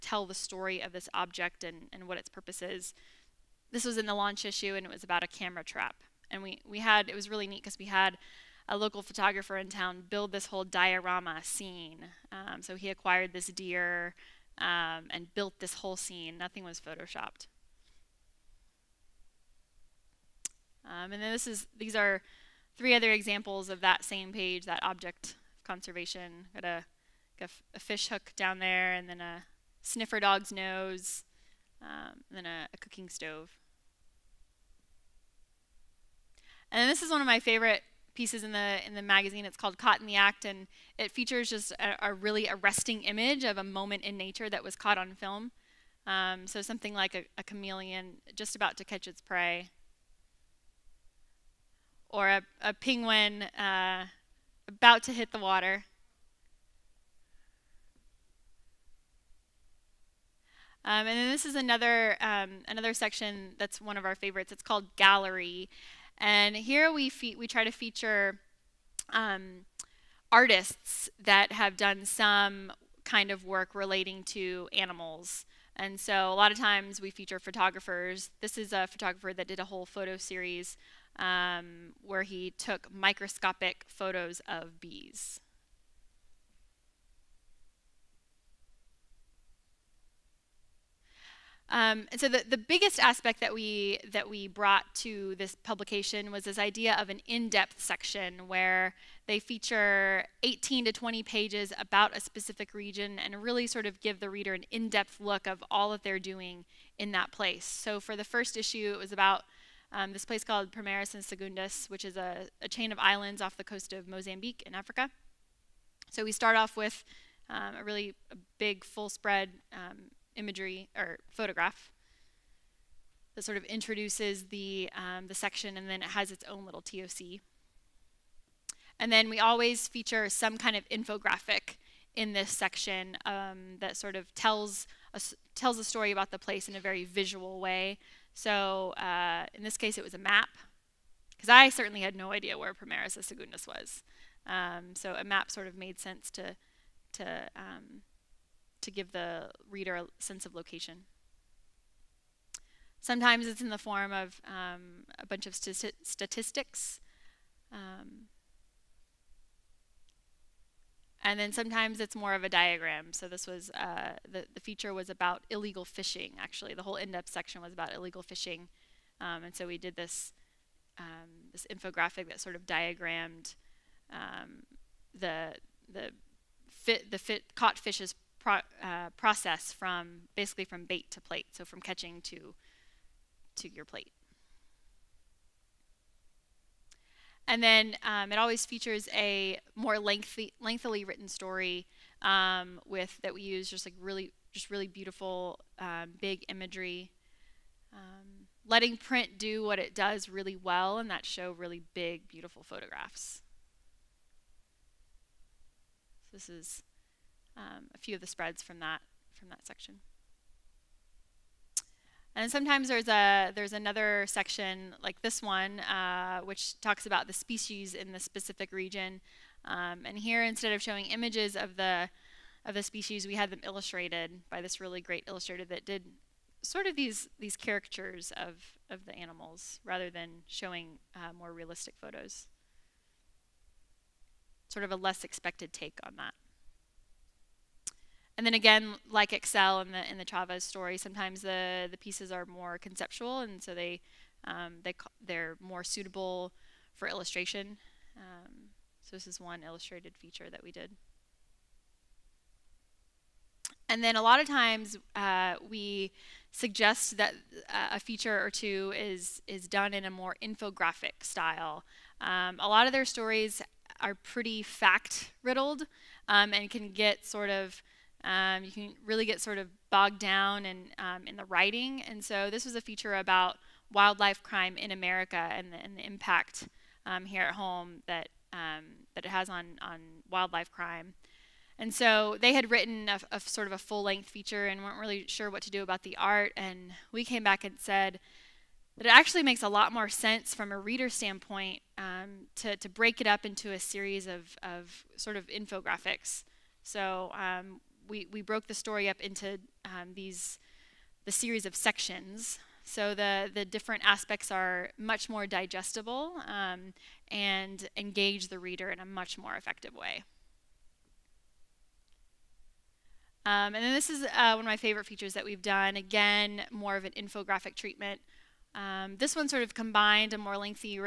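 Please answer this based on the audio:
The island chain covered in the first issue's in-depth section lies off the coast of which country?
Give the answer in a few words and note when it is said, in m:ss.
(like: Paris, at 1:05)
Mozambique, at 1:54.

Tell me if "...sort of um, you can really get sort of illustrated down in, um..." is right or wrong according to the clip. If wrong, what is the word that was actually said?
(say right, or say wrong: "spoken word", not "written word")
wrong: "bogged", not "illustrated".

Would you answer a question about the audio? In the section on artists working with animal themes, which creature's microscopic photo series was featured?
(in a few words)
Bees.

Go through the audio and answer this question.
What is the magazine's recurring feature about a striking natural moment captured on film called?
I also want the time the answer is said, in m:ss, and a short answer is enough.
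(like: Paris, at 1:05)
Caught in the Act, at 0:39.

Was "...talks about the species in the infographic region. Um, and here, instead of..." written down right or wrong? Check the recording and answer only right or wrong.
wrong.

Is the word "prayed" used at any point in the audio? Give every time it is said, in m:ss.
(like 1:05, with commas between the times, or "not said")
not said.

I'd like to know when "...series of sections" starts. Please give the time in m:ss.
5:01.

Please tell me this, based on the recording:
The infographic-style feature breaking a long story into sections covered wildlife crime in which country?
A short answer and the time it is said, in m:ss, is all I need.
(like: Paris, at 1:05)
America, at 4:34.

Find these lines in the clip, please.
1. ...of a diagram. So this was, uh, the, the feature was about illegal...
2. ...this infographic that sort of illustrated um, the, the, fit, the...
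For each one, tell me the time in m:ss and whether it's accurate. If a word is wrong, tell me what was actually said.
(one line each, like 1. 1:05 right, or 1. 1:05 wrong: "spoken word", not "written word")
1. 2:42 right
2. 2:51 wrong: "diagrammed", not "illustrated".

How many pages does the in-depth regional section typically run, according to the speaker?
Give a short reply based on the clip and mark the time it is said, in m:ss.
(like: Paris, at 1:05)
18 to 20, at 1:40.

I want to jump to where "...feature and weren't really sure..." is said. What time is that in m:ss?
4:44.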